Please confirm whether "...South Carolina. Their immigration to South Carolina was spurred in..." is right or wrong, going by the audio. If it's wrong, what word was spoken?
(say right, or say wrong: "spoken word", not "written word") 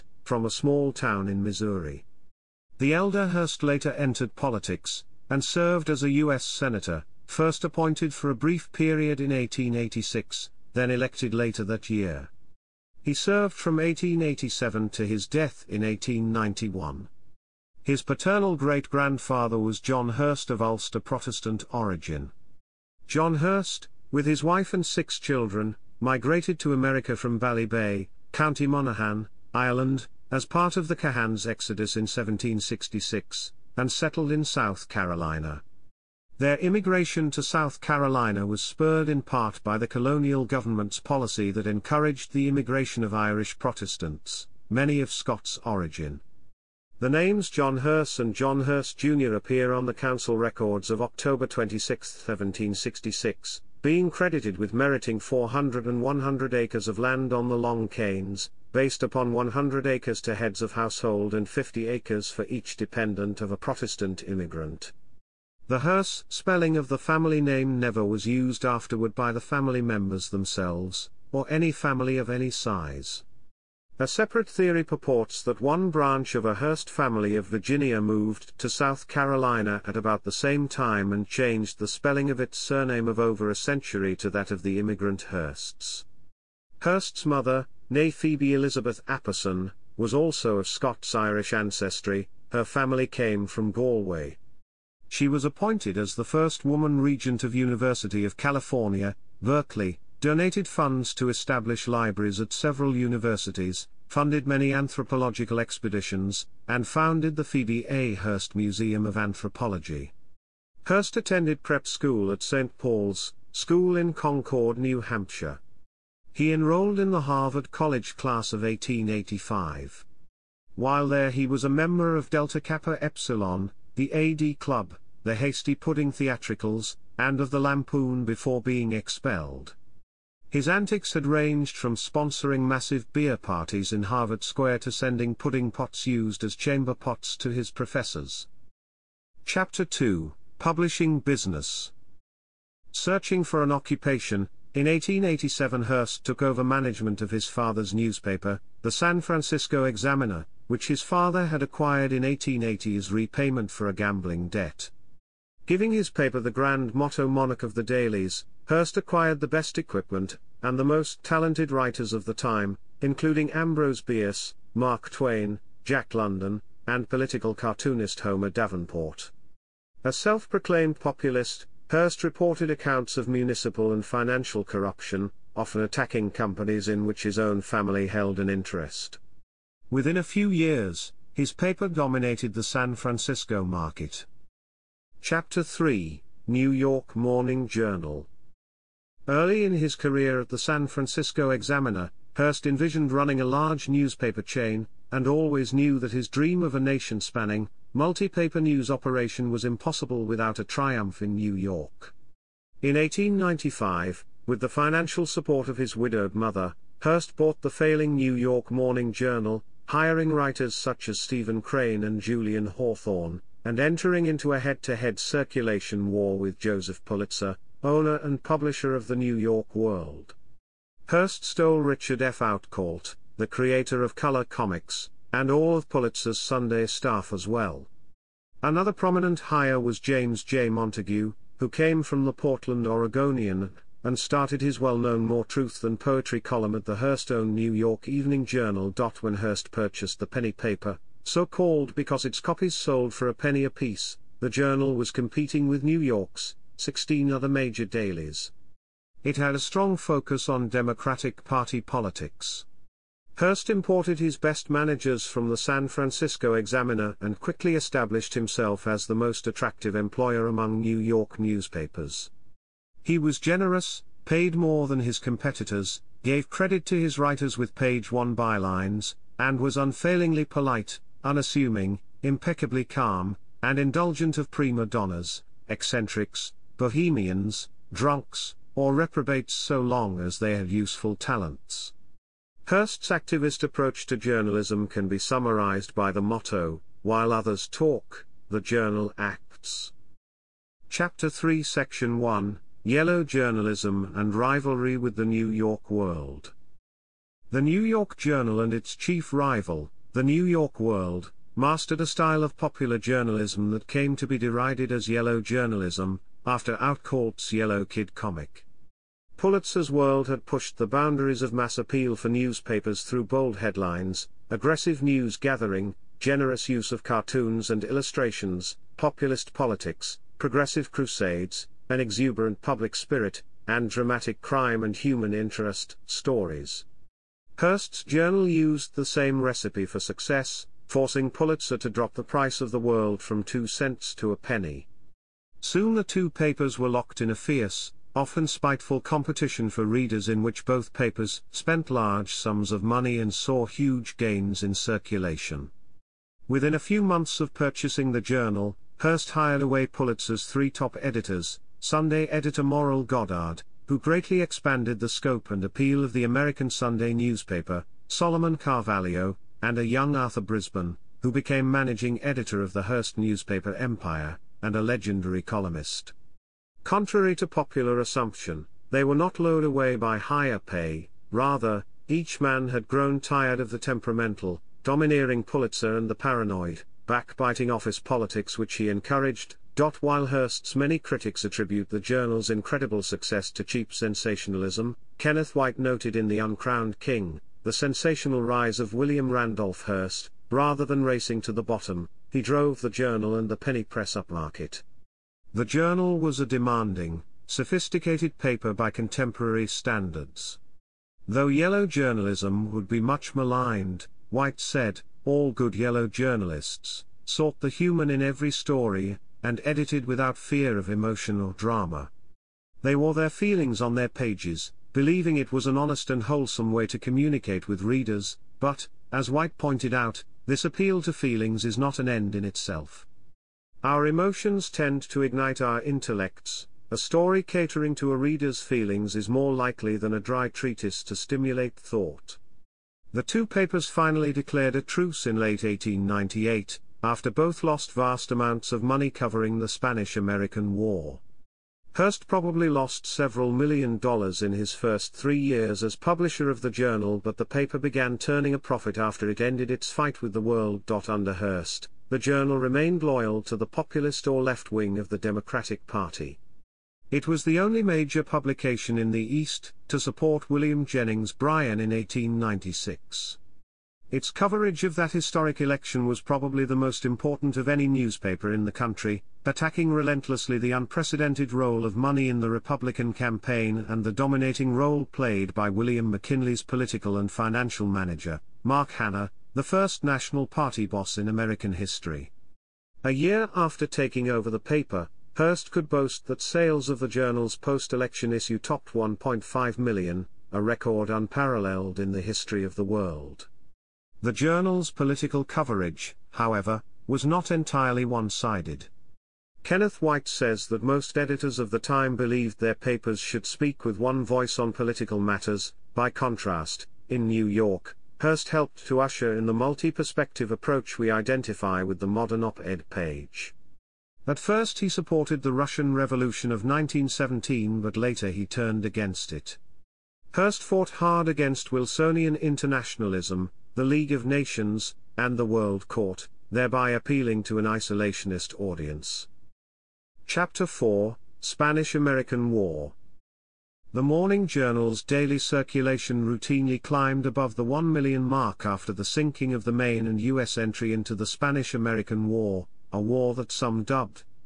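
right.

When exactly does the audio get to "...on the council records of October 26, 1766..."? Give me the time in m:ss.
0:49.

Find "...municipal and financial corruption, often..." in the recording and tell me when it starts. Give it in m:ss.
2:53.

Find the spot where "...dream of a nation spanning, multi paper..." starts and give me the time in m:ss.
3:16.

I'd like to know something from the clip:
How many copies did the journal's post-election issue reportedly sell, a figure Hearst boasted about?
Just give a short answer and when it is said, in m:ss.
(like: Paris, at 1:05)
1.5 million, at 8:08.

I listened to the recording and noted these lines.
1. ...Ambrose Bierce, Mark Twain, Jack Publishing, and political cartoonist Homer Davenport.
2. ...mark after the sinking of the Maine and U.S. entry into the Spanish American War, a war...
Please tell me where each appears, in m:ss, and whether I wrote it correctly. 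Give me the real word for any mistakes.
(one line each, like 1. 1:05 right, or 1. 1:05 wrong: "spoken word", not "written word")
1. 2:43 wrong: "London", not "Publishing"
2. 8:58 right.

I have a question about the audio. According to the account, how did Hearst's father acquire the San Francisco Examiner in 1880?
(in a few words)
Repayment for a gambling debt.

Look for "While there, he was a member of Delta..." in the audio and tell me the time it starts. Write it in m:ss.
2:00.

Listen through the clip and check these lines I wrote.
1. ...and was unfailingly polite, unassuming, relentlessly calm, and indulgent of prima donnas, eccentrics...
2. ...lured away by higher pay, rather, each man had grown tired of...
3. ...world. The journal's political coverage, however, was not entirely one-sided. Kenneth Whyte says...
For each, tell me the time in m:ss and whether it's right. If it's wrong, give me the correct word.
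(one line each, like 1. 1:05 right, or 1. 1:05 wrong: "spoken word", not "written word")
1. 4:29 wrong: "impeccably", not "relentlessly"
2. 6:09 right
3. 8:12 right.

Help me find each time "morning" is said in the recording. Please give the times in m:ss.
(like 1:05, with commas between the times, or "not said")
3:07, 3:28, 8:54.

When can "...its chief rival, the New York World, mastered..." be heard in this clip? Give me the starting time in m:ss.
4:58.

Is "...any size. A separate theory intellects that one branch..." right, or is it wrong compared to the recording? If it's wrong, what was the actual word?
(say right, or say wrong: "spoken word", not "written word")
wrong: "purports", not "intellects".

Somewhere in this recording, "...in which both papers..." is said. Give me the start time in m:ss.
5:40.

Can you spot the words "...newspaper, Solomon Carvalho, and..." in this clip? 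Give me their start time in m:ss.
5:57.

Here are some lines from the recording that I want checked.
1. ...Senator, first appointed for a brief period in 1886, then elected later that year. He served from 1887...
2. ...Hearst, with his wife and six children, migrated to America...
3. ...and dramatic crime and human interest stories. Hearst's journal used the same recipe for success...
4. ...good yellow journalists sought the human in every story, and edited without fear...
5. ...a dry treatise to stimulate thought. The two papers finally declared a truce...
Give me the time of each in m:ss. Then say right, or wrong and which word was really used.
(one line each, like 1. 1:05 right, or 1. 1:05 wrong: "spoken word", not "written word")
1. 0:06 right
2. 0:23 right
3. 5:23 right
4. 6:45 right
5. 7:10 right.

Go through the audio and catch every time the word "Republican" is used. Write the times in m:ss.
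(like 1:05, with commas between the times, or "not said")
7:52.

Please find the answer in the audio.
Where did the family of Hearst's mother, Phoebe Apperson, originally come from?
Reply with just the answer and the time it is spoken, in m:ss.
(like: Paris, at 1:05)
Galway, at 1:33.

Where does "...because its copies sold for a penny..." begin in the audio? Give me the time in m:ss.
4:01.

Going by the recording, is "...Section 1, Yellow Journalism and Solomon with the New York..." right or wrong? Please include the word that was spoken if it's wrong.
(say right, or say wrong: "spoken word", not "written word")
wrong: "Rivalry", not "Solomon".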